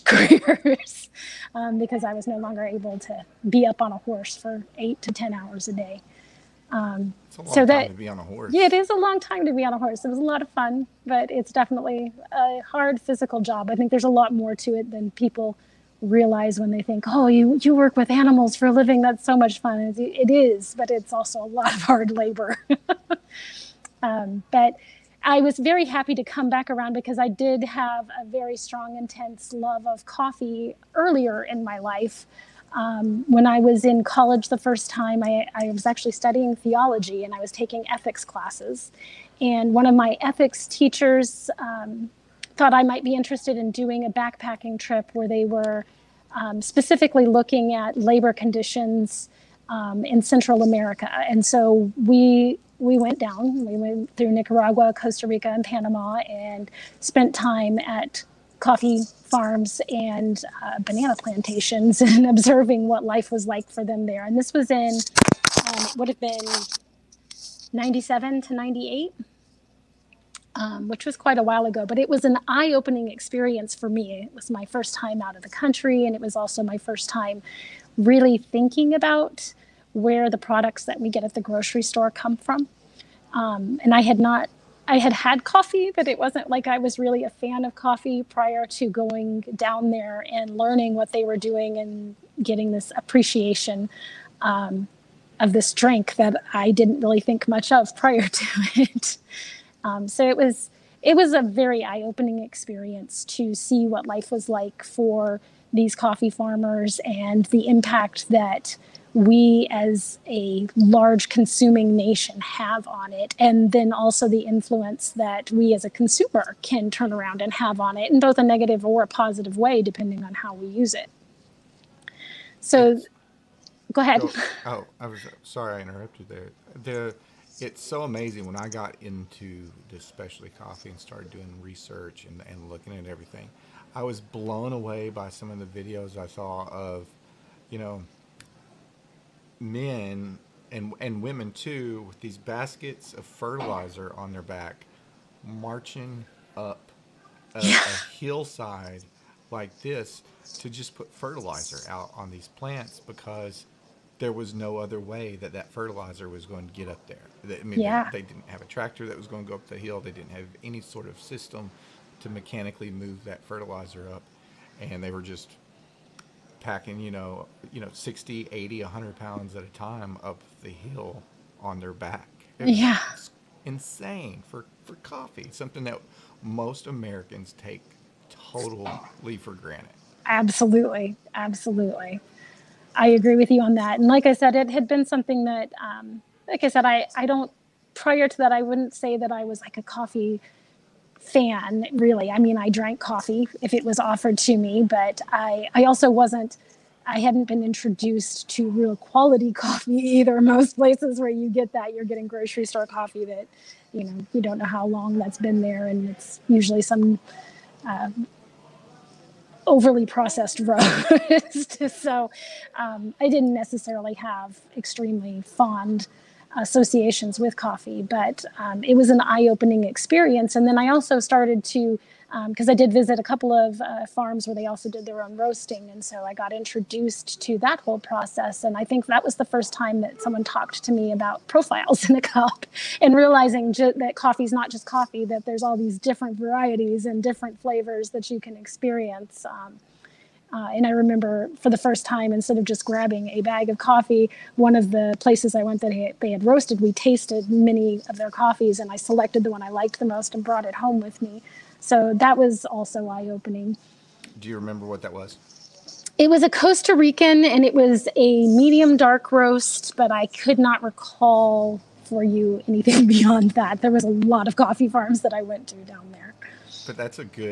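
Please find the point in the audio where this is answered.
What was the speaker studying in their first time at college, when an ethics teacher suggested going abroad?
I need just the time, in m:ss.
0:36.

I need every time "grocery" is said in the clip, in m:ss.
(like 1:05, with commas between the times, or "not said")
1:21, 3:22.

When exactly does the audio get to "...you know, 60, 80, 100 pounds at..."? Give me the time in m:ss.
2:47.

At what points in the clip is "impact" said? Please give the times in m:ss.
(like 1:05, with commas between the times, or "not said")
1:47.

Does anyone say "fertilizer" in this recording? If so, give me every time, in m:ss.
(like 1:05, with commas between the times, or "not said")
2:23, 2:31, 2:35, 2:43.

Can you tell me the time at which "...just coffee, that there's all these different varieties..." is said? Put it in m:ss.
3:54.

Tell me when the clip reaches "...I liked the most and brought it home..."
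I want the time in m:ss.
4:09.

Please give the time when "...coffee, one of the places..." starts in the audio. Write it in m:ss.
4:03.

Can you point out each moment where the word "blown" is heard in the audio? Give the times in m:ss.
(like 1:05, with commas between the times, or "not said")
2:14.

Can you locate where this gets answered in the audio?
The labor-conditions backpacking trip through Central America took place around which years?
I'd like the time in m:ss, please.
1:07.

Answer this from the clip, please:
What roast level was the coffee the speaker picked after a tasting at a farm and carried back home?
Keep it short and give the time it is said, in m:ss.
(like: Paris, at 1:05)
Medium dark, at 4:18.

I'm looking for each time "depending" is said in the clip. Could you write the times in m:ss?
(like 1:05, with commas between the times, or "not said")
1:59.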